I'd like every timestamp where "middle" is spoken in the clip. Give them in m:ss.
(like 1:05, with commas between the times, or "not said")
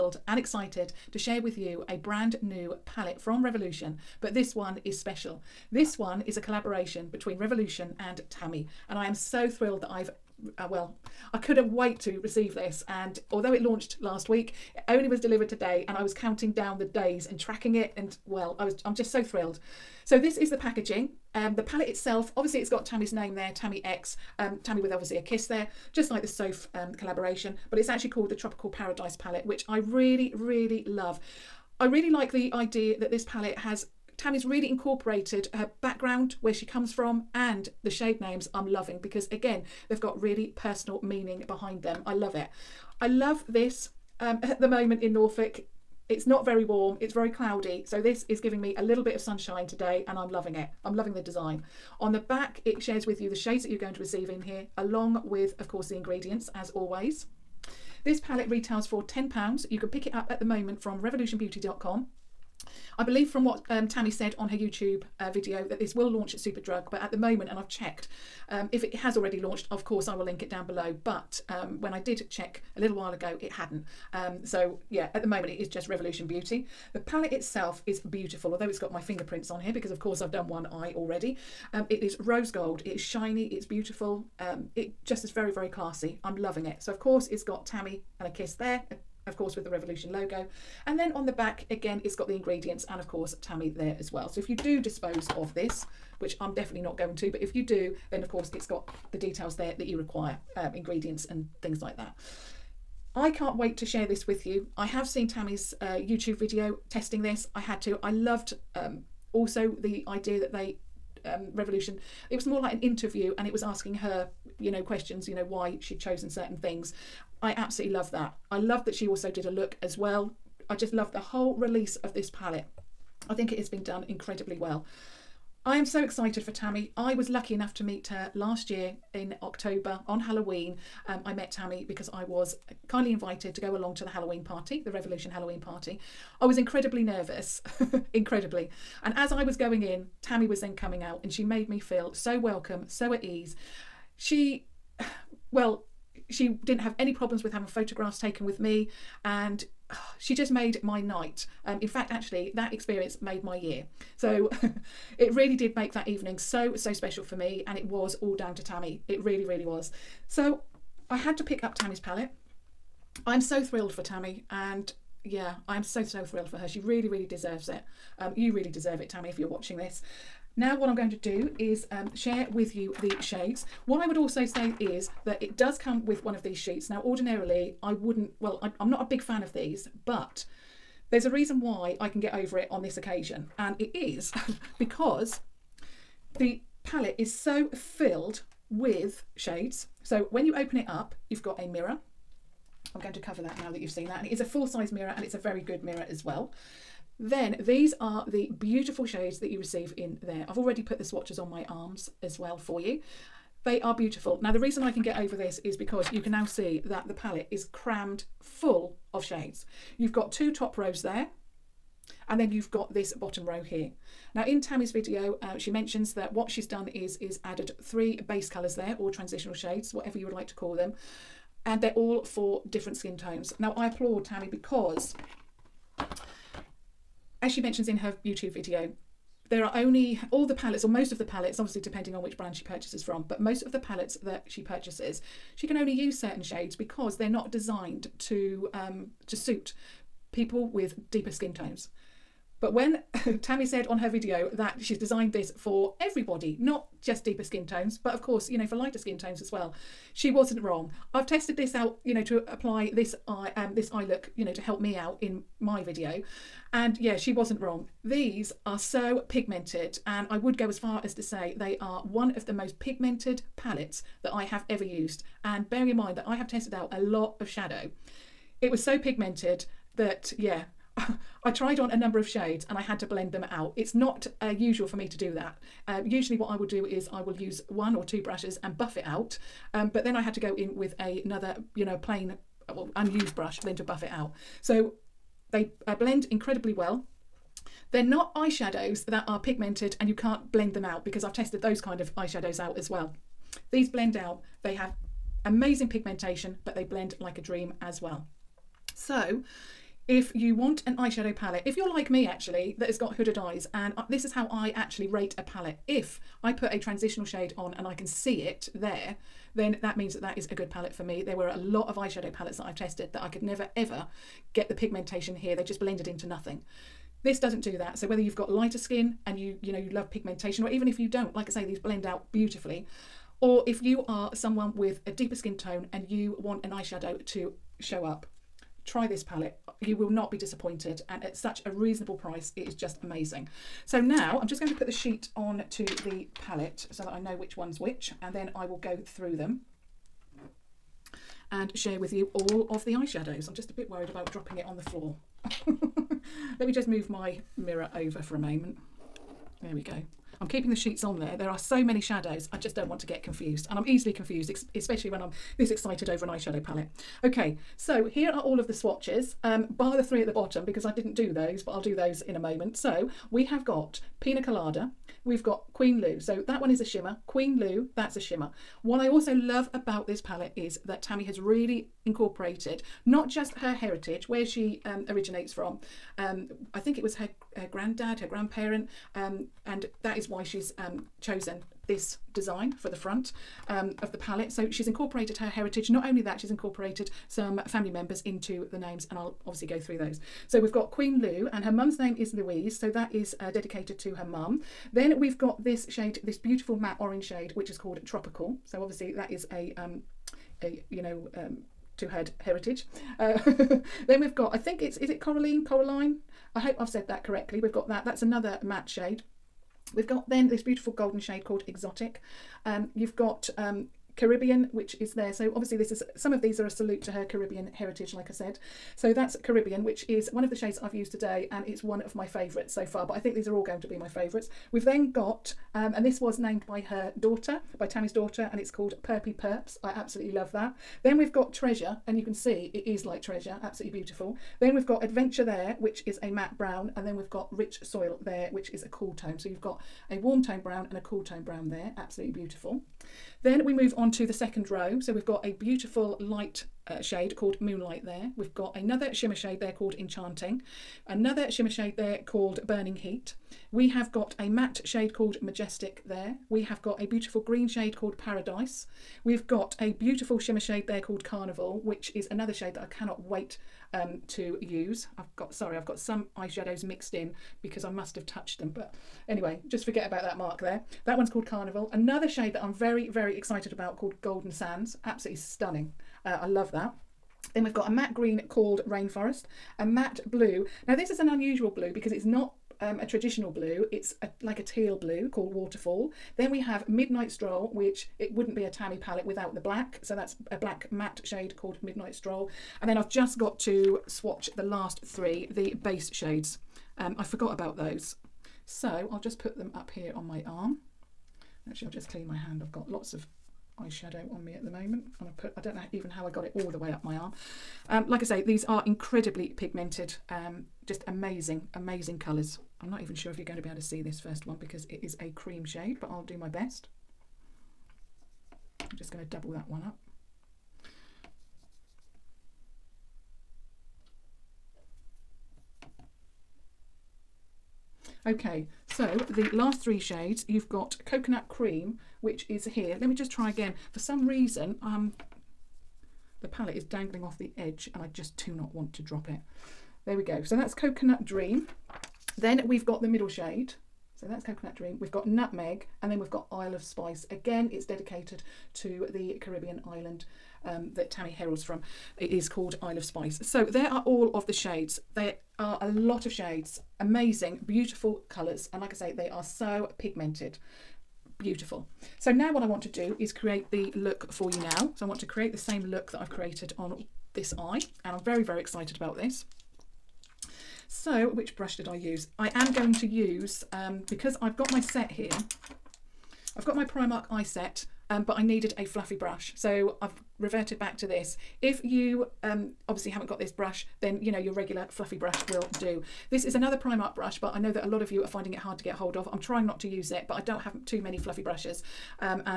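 9:03.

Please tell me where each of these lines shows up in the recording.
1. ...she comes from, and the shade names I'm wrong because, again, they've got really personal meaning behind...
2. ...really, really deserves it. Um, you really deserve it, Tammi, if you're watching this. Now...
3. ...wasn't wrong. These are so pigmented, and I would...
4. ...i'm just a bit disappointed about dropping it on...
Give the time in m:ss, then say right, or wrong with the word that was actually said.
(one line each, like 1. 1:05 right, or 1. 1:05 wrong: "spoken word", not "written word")
1. 0:36 wrong: "loving", not "wrong"
2. 2:46 right
3. 4:17 right
4. 5:43 wrong: "worried", not "disappointed".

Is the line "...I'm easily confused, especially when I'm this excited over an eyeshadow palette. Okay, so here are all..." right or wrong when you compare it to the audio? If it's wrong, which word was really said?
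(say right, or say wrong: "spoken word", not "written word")
right.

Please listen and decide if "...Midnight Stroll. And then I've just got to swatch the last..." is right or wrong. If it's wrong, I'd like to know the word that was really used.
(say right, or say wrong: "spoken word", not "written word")
right.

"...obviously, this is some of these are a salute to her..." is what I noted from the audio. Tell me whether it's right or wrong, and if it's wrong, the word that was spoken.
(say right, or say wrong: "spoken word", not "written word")
right.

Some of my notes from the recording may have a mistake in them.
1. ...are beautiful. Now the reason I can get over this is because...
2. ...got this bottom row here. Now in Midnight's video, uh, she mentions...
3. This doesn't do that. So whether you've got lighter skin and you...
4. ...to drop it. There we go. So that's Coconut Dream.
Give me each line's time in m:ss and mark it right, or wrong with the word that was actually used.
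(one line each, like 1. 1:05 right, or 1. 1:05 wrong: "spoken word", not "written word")
1. 3:23 right
2. 3:32 wrong: "Tammi", not "Midnight"
3. 5:17 right
4. 8:58 right.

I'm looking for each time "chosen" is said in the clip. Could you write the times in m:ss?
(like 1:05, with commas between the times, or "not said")
1:55, 6:21.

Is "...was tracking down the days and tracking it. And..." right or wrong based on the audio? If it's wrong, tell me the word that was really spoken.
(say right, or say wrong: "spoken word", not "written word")
wrong: "counting", not "tracking".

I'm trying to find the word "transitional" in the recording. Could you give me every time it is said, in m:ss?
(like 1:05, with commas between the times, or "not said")
3:39, 5:06.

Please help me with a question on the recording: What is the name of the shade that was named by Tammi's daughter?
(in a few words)
Perpy Perps.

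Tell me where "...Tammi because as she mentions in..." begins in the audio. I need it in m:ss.
3:44.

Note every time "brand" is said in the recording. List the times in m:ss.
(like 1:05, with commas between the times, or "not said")
0:01, 3:52.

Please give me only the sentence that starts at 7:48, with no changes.
But anyway, just forget about that mark there.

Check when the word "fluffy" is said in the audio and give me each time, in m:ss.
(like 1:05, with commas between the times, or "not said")
9:38, 9:44, 9:51.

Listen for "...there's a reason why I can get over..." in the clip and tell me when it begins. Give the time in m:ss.
3:01.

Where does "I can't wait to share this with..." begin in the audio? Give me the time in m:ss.
1:43.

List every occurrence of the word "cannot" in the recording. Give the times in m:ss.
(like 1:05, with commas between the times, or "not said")
7:42.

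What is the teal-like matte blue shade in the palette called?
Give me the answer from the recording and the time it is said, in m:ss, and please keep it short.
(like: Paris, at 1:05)
Waterfall, at 8:05.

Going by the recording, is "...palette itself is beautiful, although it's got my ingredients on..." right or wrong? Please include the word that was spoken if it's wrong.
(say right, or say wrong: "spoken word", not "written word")
wrong: "fingerprints", not "ingredients".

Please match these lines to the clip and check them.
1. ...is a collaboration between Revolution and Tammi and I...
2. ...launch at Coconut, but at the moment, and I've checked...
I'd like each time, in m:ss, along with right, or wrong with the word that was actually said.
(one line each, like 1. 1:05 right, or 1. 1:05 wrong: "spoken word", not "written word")
1. 0:06 right
2. 1:06 wrong: "Superdrug", not "Coconut".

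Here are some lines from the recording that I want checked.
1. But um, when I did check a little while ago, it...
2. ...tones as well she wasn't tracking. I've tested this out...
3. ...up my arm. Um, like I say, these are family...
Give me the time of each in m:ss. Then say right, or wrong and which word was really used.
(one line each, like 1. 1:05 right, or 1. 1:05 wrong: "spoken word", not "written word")
1. 1:11 right
2. 4:09 wrong: "wrong", not "tracking"
3. 8:26 wrong: "incredibly", not "family".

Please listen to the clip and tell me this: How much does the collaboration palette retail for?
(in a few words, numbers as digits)
£10.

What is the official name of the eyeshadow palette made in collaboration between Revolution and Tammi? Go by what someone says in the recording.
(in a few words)
Tropical Paradise.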